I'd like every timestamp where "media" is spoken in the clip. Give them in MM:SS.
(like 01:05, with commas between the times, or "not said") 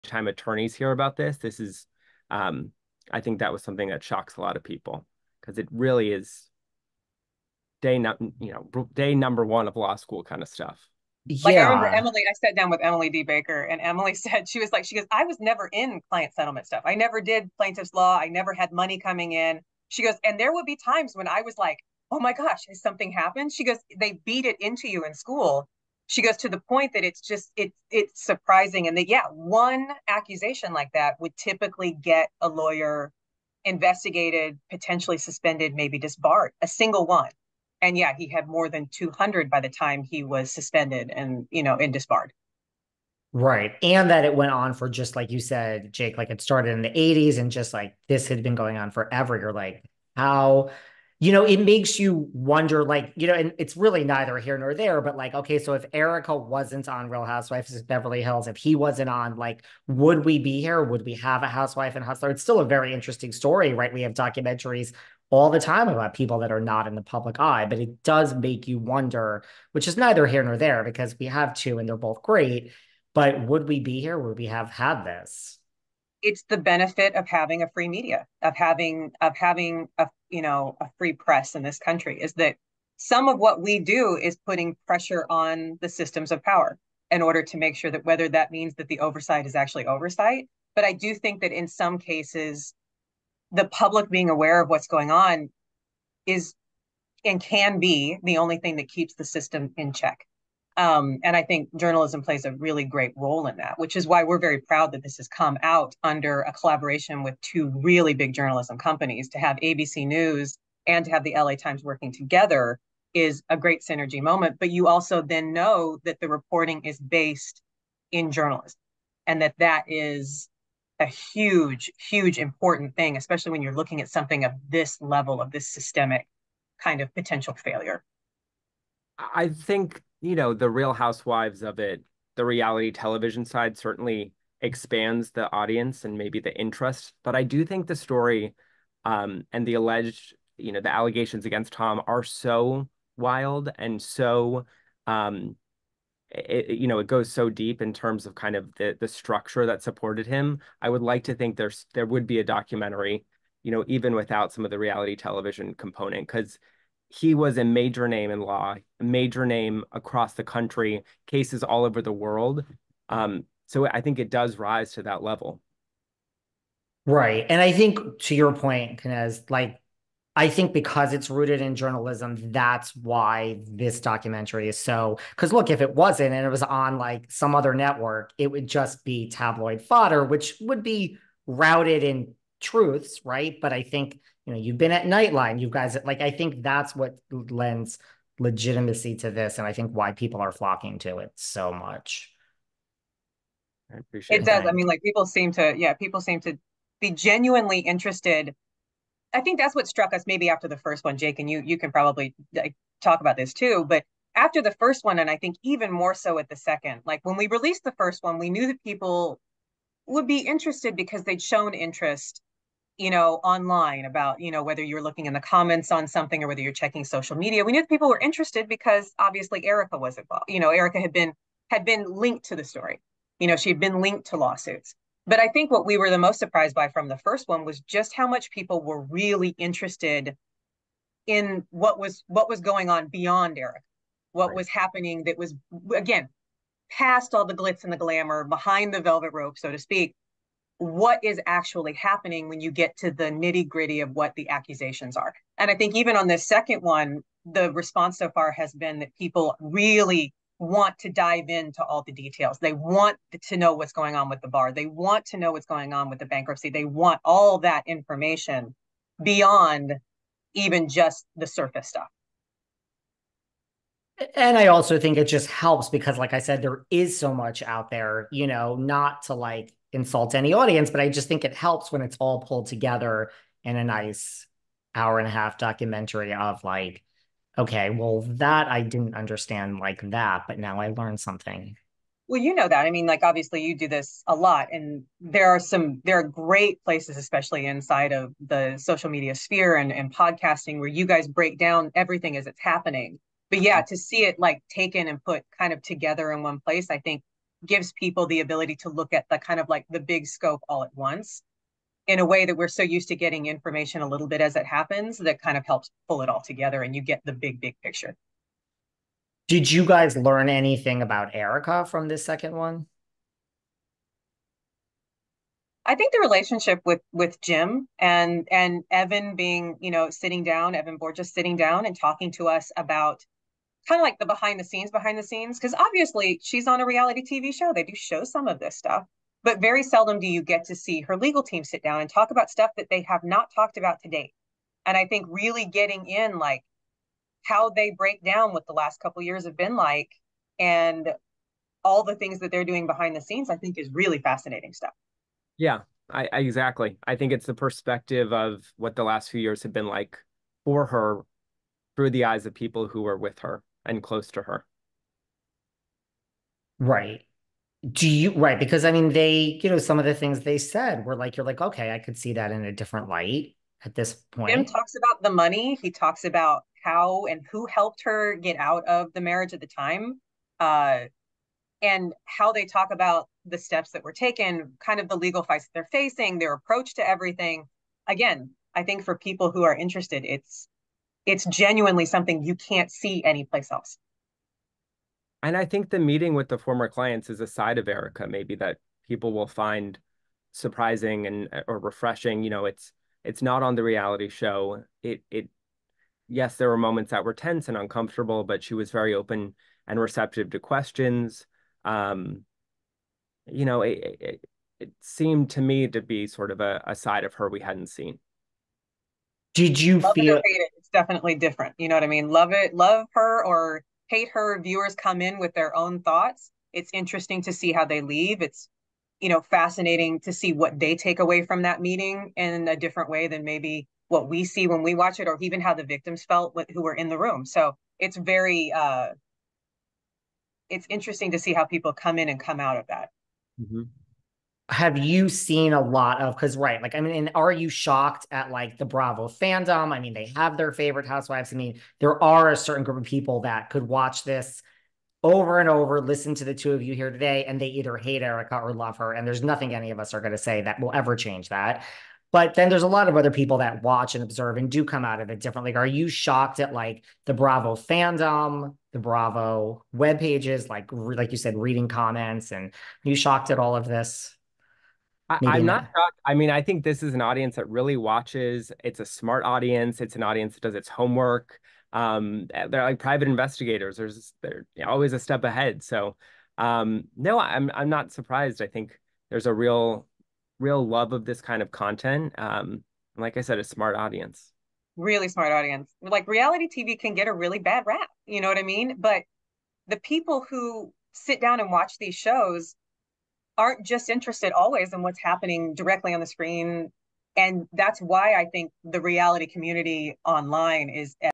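01:17, 03:37, 04:49.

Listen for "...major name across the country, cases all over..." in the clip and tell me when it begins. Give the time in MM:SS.
02:39.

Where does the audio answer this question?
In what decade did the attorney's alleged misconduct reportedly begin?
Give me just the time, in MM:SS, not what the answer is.
00:46.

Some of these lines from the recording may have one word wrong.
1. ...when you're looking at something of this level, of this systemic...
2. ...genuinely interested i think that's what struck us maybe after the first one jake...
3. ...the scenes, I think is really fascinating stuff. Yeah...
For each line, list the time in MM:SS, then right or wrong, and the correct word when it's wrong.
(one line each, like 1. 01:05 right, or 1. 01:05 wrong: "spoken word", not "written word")
1. 02:03 right
2. 03:17 right
3. 05:43 right.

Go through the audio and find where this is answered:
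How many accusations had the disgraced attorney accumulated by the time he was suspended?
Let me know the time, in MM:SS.
00:38.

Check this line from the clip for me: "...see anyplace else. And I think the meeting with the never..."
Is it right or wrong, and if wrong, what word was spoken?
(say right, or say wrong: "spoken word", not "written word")
wrong: "former", not "never".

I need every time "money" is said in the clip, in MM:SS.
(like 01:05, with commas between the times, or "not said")
00:18, 06:05.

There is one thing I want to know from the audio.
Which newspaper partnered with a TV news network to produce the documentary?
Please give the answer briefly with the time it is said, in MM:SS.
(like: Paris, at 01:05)
LA Times, at 01:51.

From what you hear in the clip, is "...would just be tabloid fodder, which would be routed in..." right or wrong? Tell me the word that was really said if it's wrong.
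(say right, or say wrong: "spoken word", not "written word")
right.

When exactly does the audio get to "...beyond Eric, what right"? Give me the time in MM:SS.
03:53.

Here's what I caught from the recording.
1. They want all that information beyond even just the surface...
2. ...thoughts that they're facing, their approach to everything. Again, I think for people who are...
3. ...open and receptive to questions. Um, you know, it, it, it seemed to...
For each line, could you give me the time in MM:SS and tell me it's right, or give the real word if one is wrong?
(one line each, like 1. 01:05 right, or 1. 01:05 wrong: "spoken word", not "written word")
1. 04:16 right
2. 06:15 wrong: "fights", not "thoughts"
3. 06:39 right.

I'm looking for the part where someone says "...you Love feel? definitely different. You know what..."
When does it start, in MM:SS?
06:49.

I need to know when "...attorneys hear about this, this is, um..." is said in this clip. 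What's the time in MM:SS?
00:00.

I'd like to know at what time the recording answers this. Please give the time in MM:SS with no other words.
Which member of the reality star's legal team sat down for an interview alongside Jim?
05:20.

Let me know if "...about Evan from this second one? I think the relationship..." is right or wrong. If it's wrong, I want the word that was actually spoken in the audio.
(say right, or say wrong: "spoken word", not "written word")
wrong: "Erika", not "Evan".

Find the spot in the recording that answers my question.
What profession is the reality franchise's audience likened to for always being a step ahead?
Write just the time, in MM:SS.
07:52.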